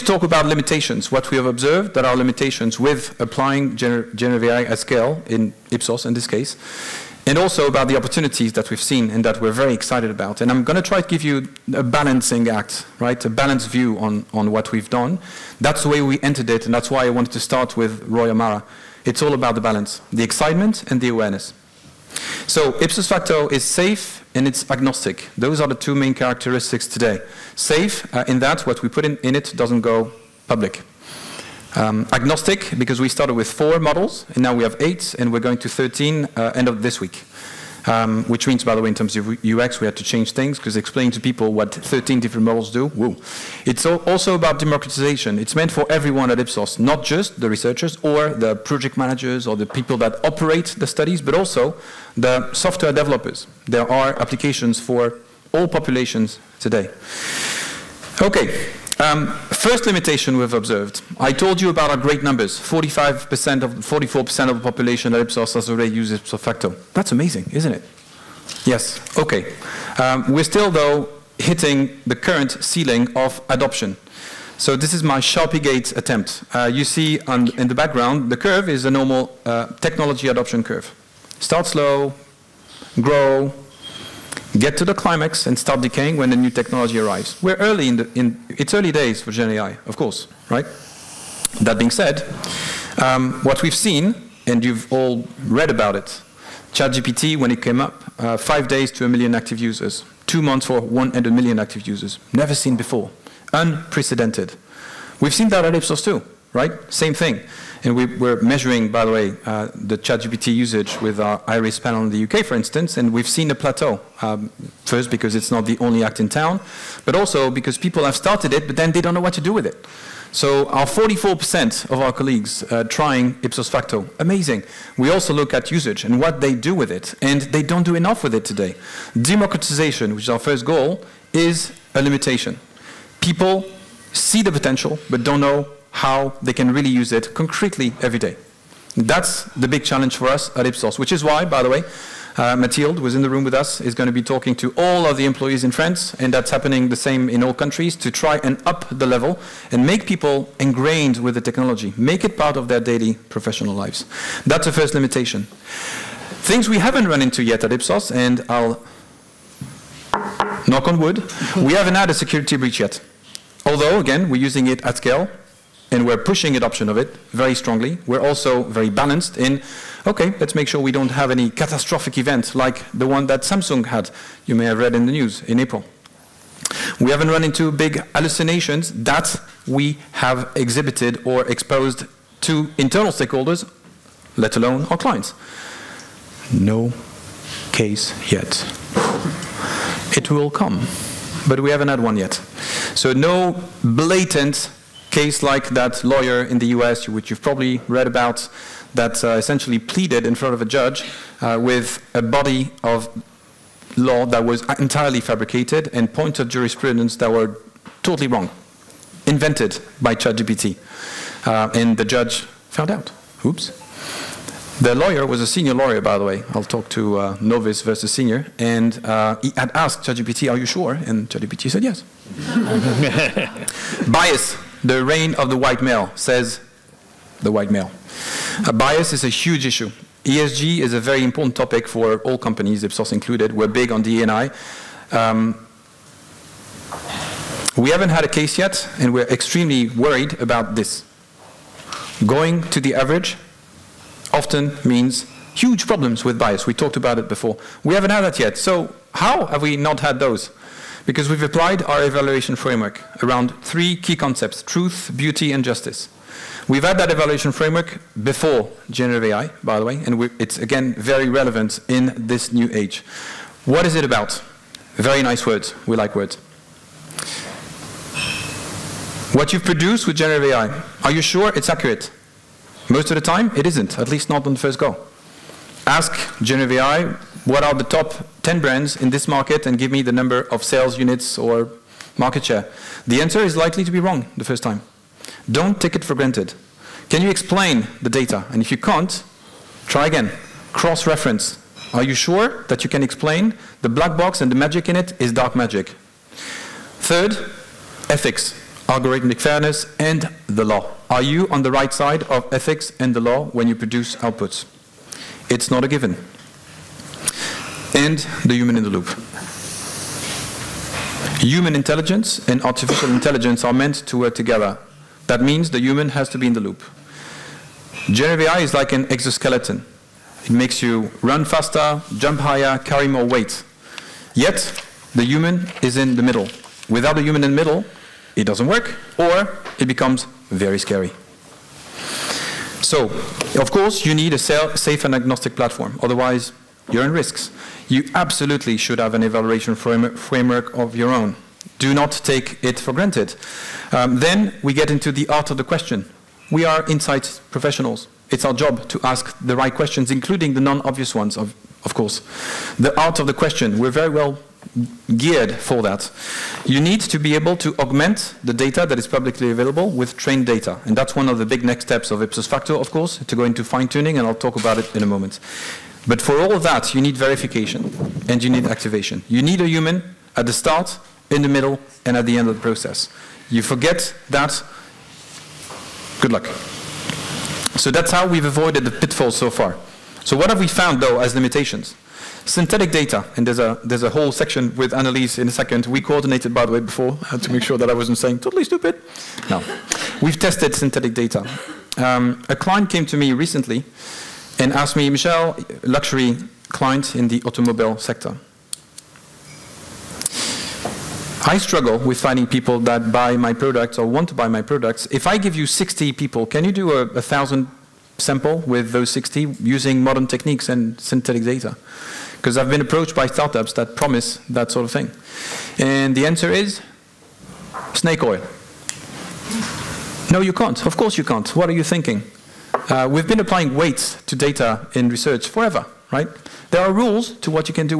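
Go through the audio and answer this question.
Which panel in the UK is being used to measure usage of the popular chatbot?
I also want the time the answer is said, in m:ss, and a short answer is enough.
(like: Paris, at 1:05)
IRIS, at 1:51.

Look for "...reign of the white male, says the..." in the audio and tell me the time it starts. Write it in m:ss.
3:45.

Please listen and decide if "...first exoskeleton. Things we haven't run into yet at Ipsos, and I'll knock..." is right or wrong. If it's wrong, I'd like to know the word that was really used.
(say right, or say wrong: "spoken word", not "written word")
wrong: "limitation", not "exoskeleton".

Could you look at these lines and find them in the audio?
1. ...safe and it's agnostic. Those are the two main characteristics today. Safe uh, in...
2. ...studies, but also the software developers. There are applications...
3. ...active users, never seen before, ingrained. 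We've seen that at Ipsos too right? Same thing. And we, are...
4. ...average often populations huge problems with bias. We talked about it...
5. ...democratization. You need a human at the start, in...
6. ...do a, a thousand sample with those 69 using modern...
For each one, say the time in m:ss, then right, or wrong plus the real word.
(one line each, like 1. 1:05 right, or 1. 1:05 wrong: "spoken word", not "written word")
1. 0:23 right
2. 0:50 right
3. 1:41 wrong: "unprecedented", not "ingrained"
4. 4:02 wrong: "means", not "populations"
5. 6:08 wrong: "activation", not "democratization"
6. 6:46 wrong: "60", not "69".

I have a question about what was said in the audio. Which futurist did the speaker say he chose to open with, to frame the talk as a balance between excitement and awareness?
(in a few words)
Roy Amara.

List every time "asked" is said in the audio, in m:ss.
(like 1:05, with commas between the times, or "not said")
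3:39, 6:34.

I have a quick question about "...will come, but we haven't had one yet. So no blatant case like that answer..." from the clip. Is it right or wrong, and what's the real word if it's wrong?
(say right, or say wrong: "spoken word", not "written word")
wrong: "lawyer", not "answer".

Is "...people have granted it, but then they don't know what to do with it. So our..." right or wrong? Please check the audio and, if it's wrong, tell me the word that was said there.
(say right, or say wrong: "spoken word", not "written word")
wrong: "started", not "granted".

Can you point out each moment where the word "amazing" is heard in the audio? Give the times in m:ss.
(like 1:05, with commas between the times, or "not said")
1:07, 2:04.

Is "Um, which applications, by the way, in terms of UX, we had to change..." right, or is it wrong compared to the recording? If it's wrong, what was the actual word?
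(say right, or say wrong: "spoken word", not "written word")
wrong: "means", not "applications".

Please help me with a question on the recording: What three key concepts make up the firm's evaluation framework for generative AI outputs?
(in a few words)
truth, beauty, and justice.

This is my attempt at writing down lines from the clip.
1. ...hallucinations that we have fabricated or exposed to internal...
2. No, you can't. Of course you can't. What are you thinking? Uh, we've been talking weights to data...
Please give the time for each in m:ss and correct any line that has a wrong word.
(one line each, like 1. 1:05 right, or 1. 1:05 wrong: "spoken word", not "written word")
1. 2:58 wrong: "exhibited", not "fabricated"
2. 7:00 wrong: "applying", not "talking".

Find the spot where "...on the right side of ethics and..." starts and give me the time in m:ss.
5:01.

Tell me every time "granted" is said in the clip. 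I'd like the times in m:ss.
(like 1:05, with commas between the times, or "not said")
4:46, 5:42.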